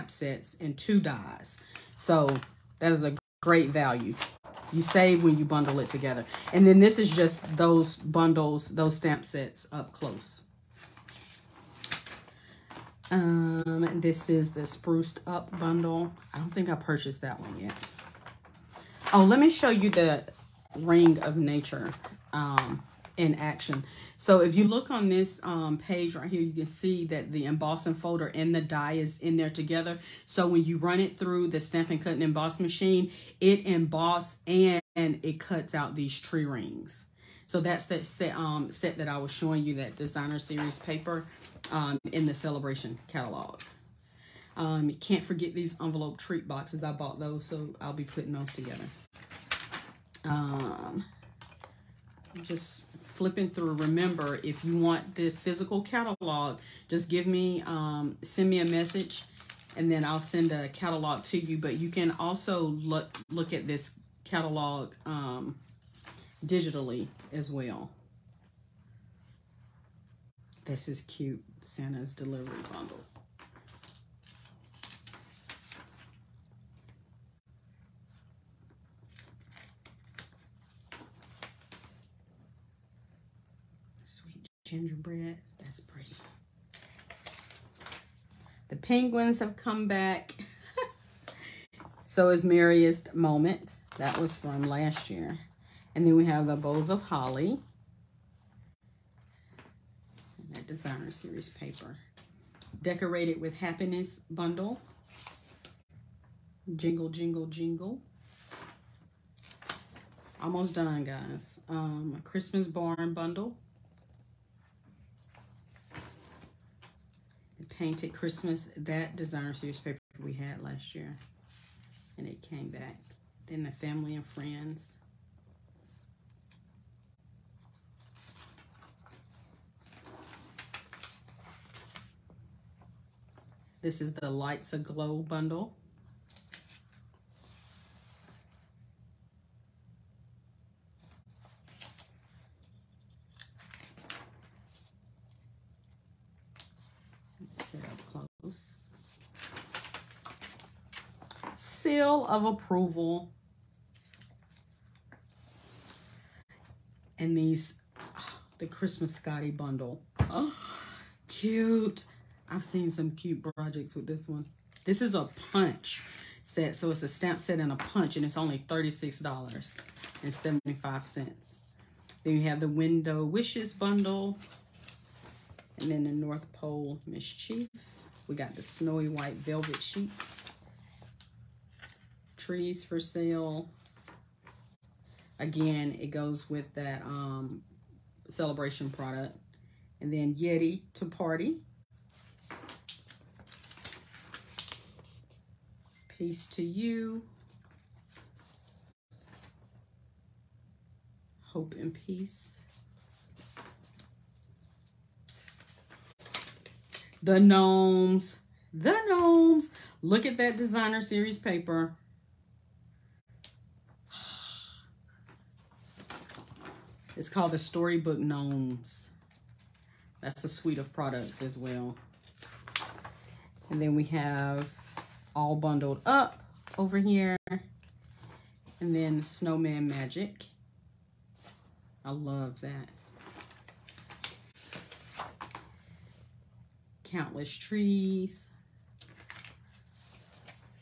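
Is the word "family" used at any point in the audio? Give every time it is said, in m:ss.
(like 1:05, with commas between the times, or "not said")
2:03.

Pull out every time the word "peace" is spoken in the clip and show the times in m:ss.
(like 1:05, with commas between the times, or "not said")
3:16, 3:21.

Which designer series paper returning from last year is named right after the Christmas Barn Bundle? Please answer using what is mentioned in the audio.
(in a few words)
Painted Christmas.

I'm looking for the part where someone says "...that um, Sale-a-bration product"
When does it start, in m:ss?
3:06.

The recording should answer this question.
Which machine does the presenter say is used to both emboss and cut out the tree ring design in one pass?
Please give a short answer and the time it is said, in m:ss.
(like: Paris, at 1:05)
Stampin' Cut and Emboss machine, at 0:31.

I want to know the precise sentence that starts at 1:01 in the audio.
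But you can also look, look at this catalog um, digitally as well.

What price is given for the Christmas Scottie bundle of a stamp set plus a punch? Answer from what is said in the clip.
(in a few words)
$36.75.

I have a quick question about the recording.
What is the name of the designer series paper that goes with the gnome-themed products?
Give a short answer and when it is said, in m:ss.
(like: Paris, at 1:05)
Storybook Gnomes, at 3:37.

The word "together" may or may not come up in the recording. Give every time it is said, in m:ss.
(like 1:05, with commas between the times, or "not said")
0:05, 0:29, 0:48.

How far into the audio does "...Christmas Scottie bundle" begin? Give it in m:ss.
2:38.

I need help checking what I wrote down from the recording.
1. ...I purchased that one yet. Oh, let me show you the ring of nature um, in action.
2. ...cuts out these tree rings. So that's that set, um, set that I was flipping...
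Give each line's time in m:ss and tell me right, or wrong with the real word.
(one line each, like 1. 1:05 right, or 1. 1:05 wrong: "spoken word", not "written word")
1. 0:16 right
2. 0:35 wrong: "showing", not "flipping".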